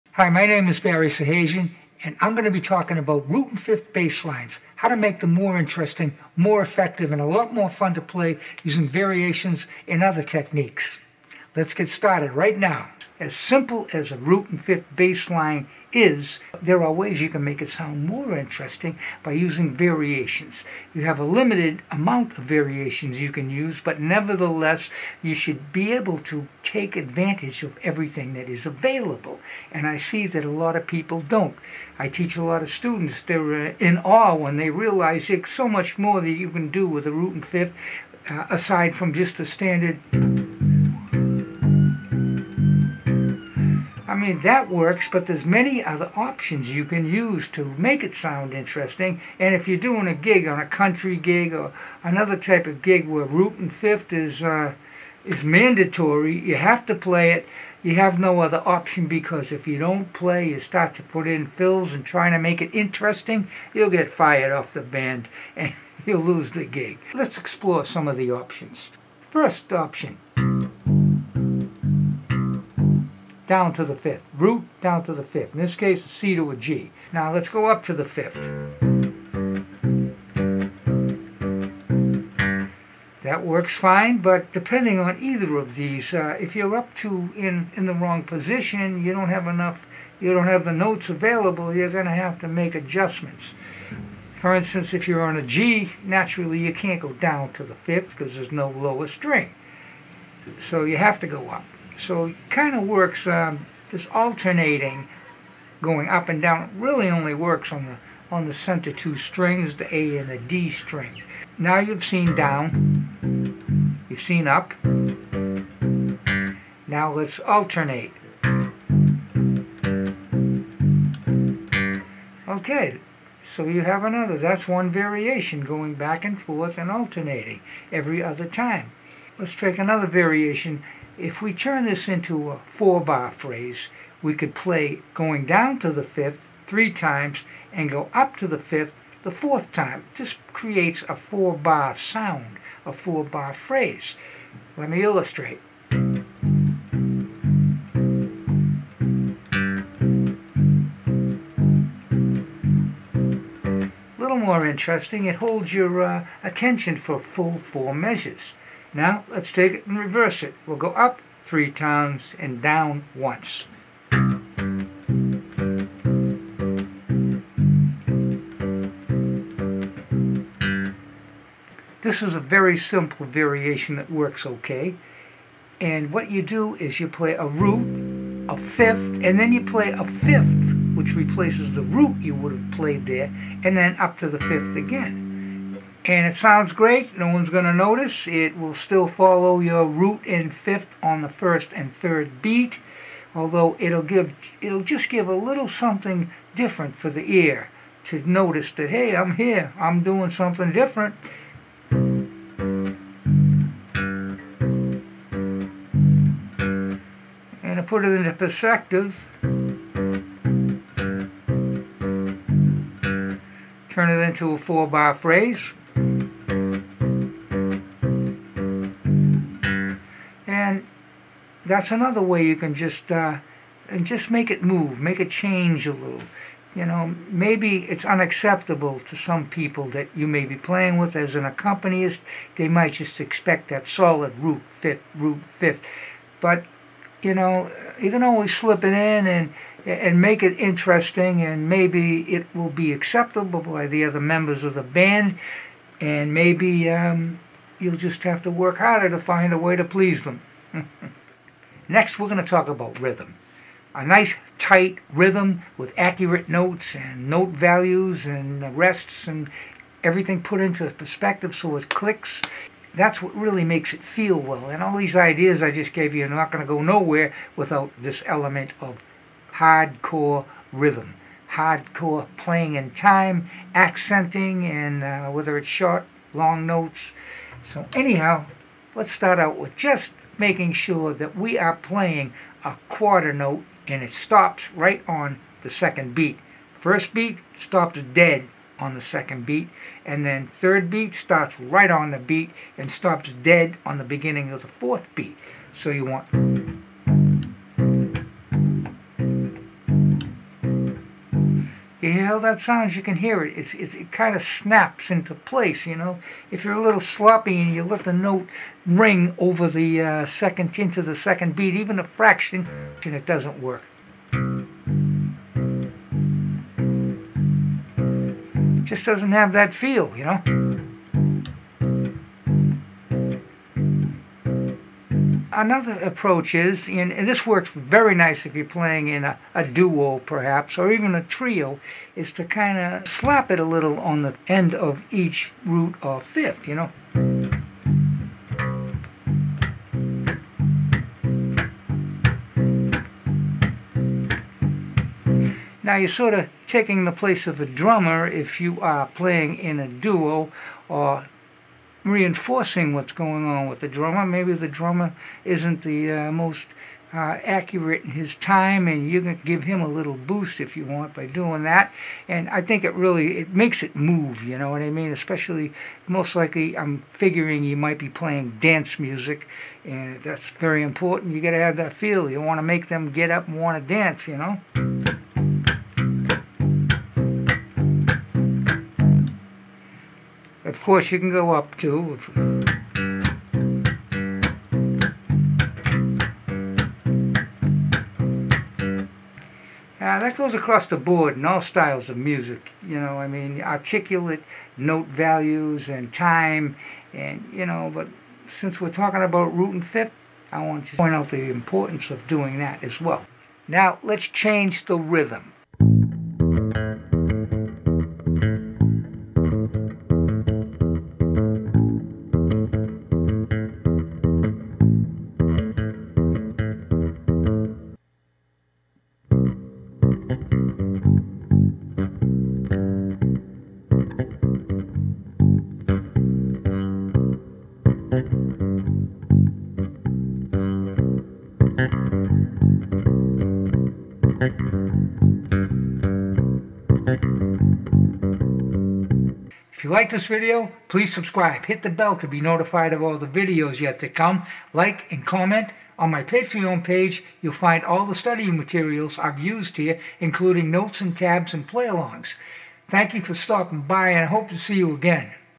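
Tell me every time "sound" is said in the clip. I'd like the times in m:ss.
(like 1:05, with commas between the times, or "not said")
0:17, 0:48, 2:21, 3:06, 5:02.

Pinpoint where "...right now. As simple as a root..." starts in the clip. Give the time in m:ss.
0:12.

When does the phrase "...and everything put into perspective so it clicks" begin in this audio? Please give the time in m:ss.
4:19.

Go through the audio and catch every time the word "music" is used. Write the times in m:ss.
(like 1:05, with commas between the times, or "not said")
6:08, 6:32.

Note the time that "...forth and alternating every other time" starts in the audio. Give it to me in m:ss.
2:06.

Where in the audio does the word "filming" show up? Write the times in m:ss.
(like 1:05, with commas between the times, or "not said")
not said.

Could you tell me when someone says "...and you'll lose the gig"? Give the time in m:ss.
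1:05.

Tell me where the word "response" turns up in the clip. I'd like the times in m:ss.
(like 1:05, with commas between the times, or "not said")
not said.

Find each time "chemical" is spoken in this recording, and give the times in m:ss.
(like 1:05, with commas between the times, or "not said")
not said.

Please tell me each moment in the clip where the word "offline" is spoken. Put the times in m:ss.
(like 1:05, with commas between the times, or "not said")
not said.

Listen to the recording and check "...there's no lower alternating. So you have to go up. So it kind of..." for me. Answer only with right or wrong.
wrong.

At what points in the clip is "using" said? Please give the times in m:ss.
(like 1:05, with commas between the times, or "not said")
0:08, 0:19.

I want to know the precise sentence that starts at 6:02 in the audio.
And I think it really it makes it move.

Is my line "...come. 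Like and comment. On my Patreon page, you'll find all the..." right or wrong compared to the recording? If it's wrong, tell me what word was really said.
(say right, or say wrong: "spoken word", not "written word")
right.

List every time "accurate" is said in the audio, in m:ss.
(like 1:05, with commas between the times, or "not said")
4:15, 5:57.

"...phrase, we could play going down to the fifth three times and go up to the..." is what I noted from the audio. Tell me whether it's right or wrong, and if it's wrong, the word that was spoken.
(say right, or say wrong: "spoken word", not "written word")
right.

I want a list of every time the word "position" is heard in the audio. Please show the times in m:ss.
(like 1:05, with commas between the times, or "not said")
1:28.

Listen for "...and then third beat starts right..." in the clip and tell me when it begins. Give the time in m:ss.
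4:50.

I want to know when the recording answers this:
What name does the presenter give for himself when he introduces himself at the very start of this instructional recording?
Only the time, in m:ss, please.
0:00.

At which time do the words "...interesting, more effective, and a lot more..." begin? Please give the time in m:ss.
0:05.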